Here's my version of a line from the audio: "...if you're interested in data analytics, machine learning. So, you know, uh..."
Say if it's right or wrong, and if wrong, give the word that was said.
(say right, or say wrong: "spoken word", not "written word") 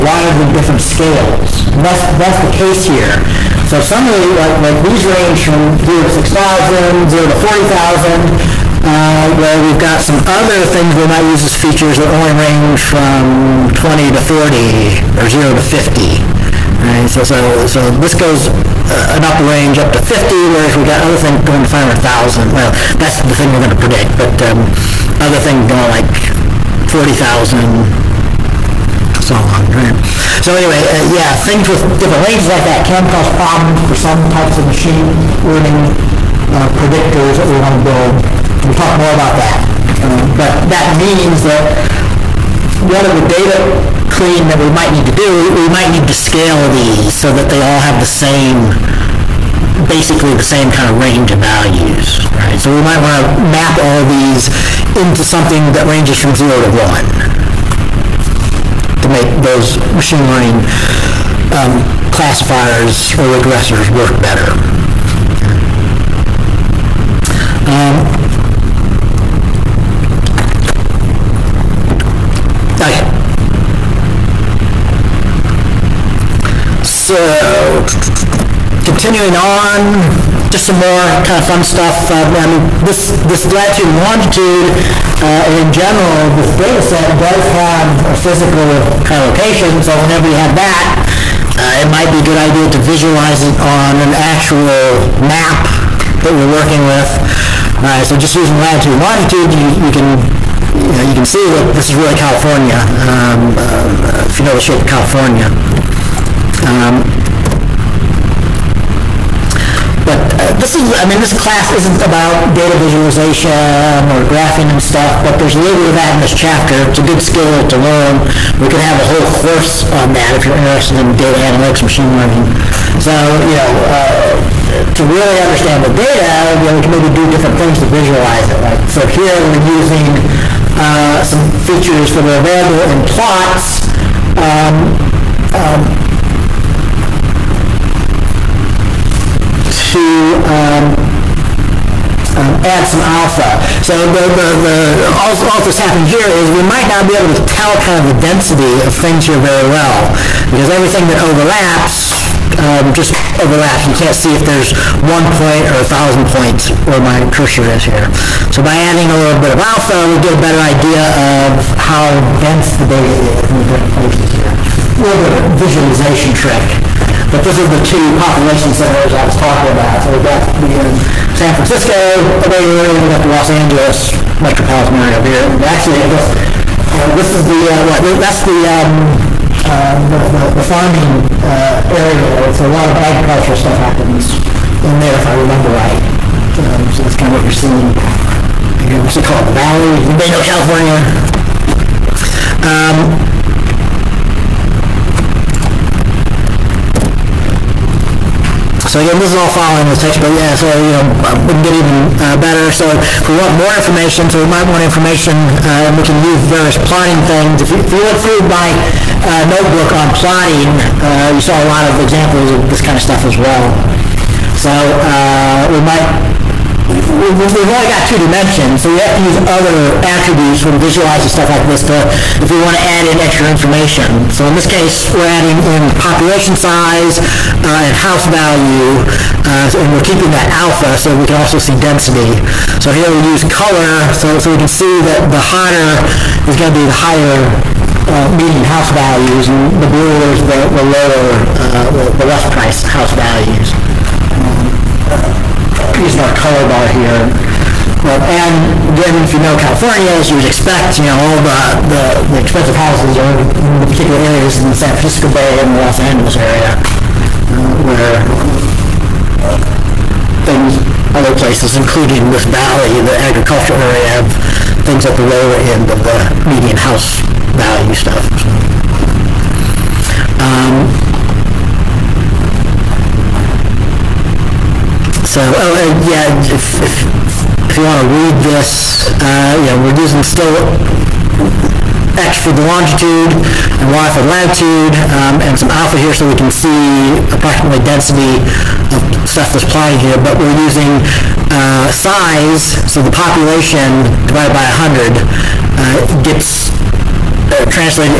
right.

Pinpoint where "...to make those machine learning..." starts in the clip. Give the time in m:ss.
0:59.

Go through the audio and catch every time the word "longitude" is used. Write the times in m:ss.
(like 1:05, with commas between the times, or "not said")
1:24, 1:39, 4:42.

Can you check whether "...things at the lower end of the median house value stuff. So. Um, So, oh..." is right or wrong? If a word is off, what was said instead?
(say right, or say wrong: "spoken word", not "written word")
right.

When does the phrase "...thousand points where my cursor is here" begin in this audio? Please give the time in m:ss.
2:35.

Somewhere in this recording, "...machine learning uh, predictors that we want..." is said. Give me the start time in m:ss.
0:34.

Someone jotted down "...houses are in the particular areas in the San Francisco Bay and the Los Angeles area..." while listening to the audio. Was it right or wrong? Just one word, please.
right.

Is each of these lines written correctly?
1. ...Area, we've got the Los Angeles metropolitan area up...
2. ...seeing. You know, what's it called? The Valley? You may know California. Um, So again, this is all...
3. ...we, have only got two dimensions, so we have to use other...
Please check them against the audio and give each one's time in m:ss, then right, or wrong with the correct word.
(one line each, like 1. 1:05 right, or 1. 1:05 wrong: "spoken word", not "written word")
1. 2:52 right
2. 3:07 right
3. 3:36 right.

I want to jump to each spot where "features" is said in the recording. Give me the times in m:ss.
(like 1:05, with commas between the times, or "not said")
0:11, 2:11.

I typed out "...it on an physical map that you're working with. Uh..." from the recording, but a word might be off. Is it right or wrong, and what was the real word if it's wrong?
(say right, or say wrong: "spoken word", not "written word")
wrong: "actual", not "physical".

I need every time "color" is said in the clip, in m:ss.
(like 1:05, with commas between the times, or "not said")
3:53, 4:06.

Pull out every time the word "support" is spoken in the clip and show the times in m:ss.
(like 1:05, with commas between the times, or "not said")
not said.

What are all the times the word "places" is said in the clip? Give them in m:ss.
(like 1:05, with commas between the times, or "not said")
2:43, 4:21.